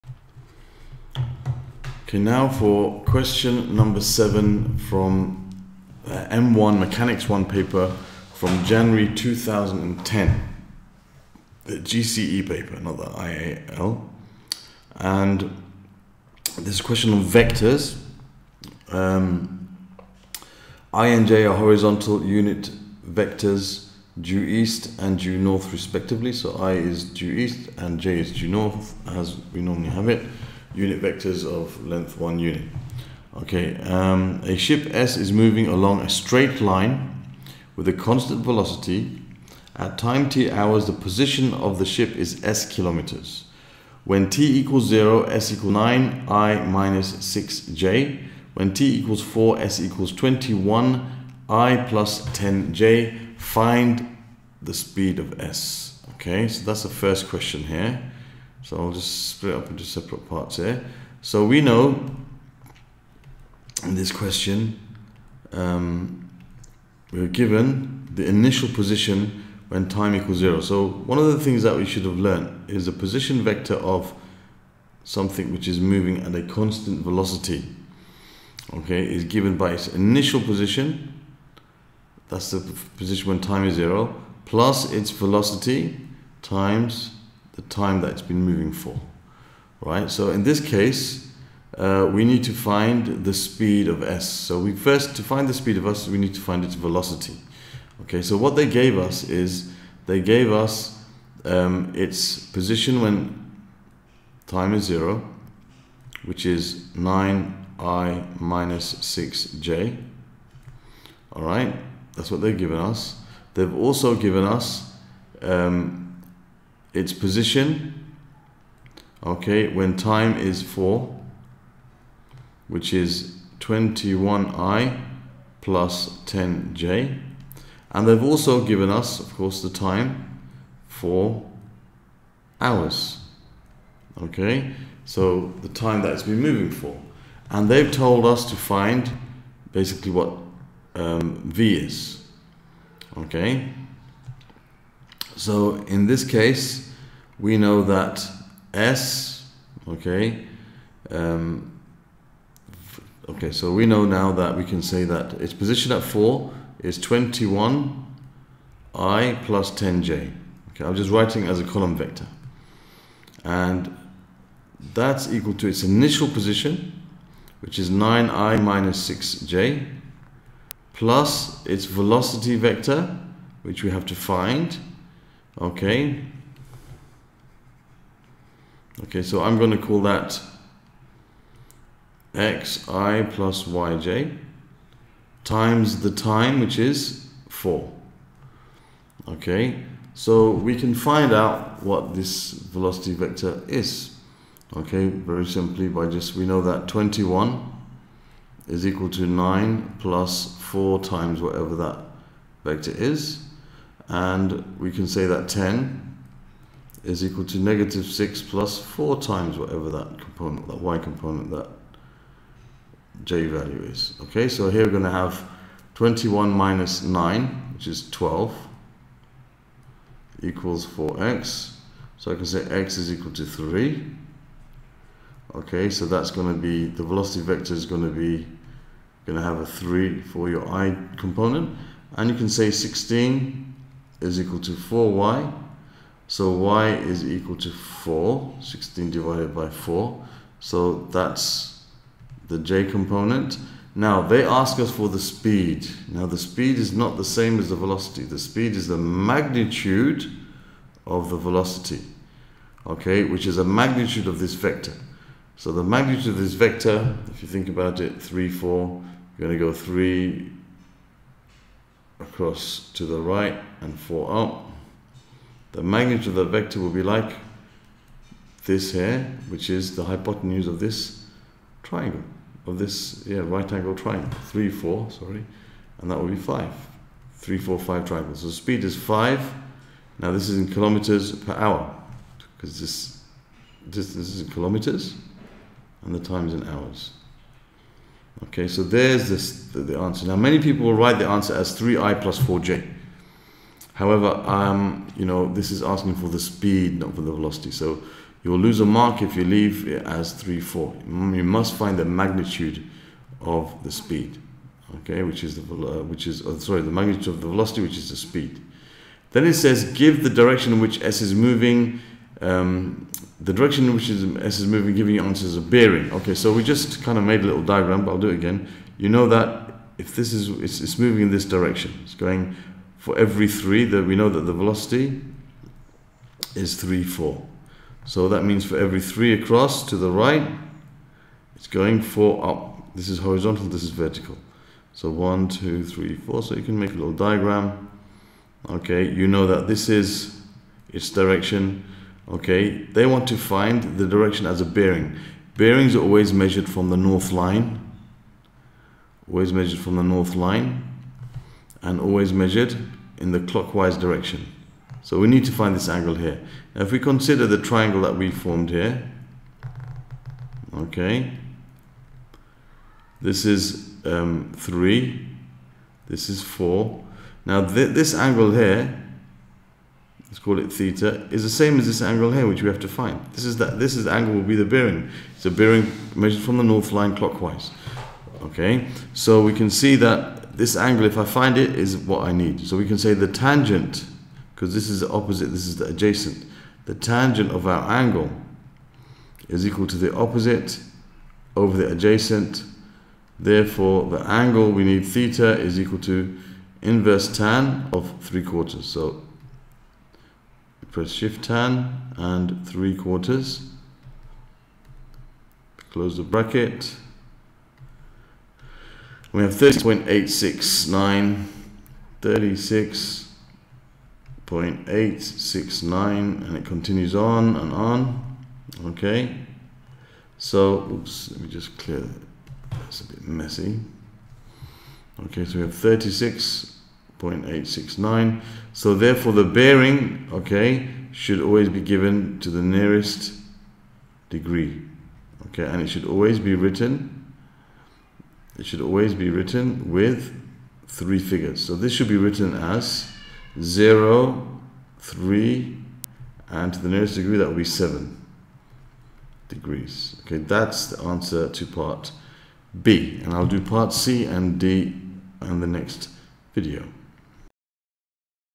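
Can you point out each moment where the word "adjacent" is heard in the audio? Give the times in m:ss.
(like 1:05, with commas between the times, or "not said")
6:25, 6:31.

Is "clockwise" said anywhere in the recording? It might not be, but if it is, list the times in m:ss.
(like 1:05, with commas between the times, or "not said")
5:53, 6:17.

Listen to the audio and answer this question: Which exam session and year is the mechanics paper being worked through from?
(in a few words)
January 2010.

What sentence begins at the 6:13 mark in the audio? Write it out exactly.
This is that this is the angle will be the bearing.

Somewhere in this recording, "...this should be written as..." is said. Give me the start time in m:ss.
7:21.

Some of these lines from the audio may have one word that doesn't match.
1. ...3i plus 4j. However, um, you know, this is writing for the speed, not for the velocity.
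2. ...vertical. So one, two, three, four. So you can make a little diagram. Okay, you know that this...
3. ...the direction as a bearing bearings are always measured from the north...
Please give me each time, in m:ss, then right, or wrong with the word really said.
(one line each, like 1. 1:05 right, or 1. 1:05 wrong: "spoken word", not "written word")
1. 4:51 wrong: "asking", not "writing"
2. 5:33 right
3. 5:43 right.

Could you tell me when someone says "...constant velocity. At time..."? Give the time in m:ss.
0:37.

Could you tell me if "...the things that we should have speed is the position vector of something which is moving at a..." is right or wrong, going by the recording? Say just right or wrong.
wrong.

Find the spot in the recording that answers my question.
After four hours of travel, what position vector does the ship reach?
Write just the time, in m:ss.
0:50.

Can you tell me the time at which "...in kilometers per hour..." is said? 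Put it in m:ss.
4:40.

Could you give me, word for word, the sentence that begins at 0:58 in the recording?
So I'll just split up into separate parts here.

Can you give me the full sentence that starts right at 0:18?
Um, I and J are horizontal unit vectors due east and due north respectively.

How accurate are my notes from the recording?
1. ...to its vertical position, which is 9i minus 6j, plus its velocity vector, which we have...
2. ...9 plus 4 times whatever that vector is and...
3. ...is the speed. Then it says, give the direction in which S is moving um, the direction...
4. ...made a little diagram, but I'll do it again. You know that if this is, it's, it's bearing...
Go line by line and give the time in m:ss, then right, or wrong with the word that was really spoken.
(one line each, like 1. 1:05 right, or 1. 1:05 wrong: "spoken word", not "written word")
1. 2:45 wrong: "initial", not "vertical"
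2. 3:19 right
3. 5:07 right
4. 5:17 wrong: "moving", not "bearing".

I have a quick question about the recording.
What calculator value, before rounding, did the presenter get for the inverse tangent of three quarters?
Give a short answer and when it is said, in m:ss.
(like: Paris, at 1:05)
36.869, at 6:52.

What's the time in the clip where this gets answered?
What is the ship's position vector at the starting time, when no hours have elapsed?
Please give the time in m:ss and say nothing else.
0:45.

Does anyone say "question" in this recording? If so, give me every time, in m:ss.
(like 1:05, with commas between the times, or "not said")
0:03, 0:16, 0:57, 1:04.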